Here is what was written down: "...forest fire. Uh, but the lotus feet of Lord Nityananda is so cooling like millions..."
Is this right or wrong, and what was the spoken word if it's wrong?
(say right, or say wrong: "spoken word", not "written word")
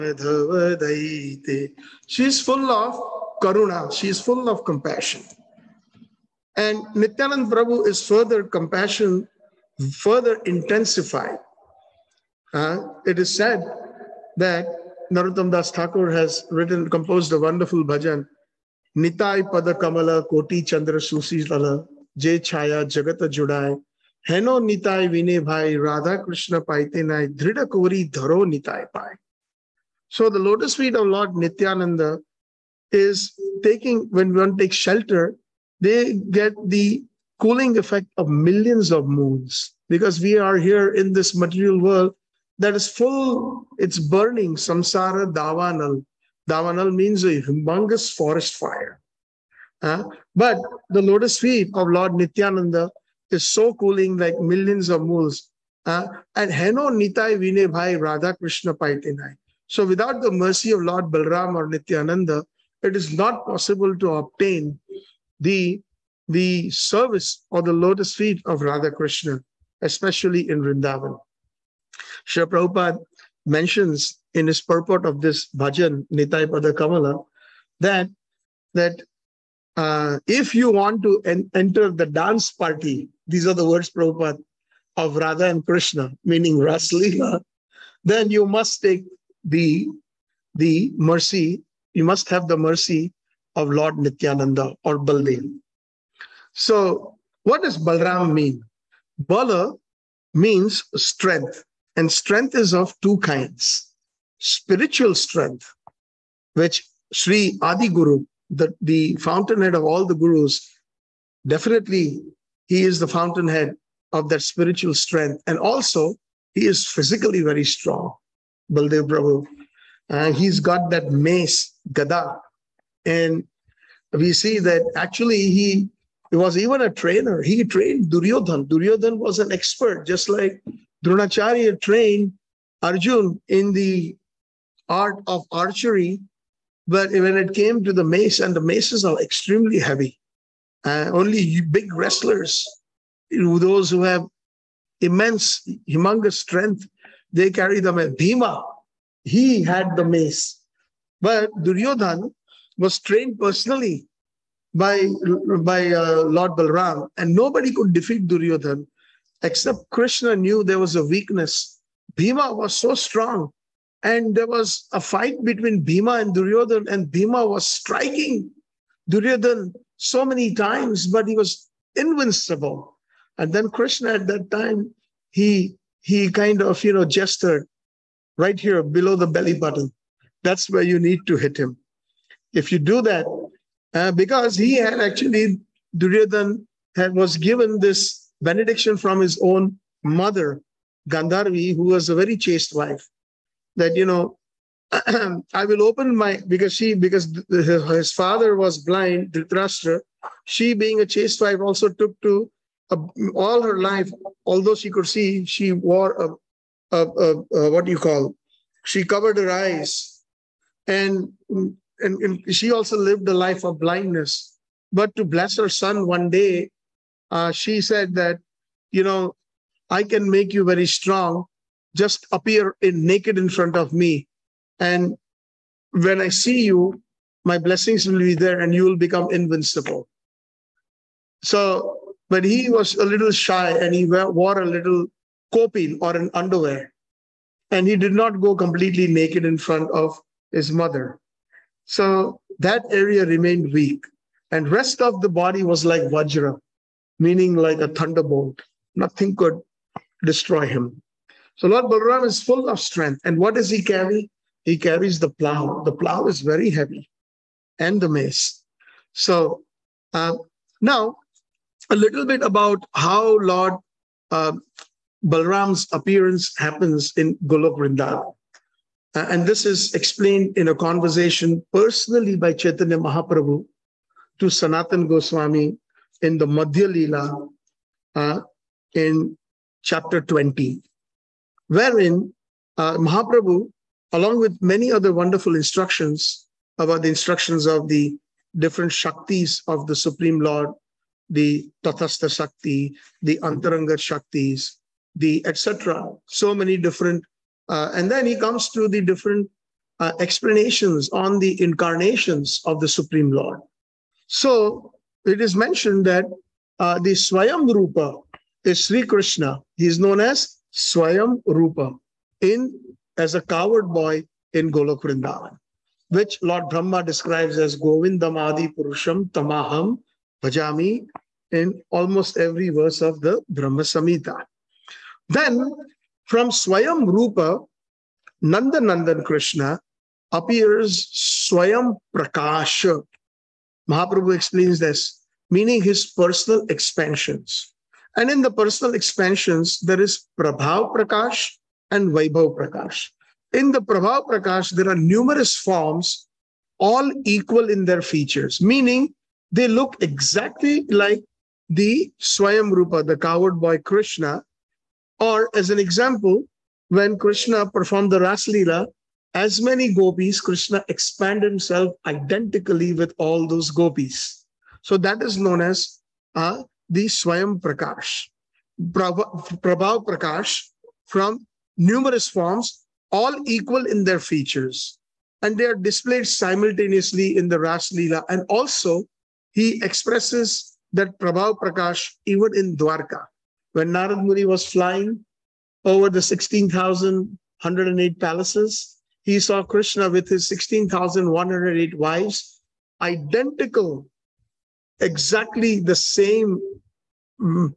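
right.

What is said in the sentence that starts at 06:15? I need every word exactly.
And they are displayed simultaneously in the Ras Leela.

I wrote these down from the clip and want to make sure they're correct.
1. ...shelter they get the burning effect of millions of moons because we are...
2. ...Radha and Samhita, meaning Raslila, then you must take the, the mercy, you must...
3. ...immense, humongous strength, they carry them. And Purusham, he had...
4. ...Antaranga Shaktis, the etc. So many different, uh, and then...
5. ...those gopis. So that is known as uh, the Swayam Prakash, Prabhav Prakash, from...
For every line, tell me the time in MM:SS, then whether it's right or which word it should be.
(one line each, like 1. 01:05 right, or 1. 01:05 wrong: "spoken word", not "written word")
1. 00:34 wrong: "cooling", not "burning"
2. 01:25 wrong: "Krishna", not "Samhita"
3. 02:24 wrong: "Bhima", not "Purusham"
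4. 04:53 right
5. 06:03 right.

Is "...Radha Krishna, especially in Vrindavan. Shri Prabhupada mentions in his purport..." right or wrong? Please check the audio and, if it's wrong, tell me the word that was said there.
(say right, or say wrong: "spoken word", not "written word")
right.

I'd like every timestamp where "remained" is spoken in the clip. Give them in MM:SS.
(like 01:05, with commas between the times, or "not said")
04:03.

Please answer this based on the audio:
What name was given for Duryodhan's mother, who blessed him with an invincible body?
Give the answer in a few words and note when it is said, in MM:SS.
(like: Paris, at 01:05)
Gandharvi, at 03:11.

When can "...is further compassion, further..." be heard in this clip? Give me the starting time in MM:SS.
00:07.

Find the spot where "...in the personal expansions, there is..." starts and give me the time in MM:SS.
05:38.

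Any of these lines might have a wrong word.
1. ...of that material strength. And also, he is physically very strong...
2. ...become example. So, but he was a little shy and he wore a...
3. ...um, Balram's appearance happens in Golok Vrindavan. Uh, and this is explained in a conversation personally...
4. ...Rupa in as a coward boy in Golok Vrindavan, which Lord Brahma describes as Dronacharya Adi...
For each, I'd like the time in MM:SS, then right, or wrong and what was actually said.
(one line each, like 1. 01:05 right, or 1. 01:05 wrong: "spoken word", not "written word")
1. 01:54 wrong: "spiritual", not "material"
2. 03:48 wrong: "invincible", not "example"
3. 04:24 right
4. 05:11 wrong: "Govindam", not "Dronacharya".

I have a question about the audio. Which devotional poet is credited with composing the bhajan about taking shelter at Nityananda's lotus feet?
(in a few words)
Narottam Das Thakur.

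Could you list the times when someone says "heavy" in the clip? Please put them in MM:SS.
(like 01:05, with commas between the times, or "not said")
02:19, 04:16.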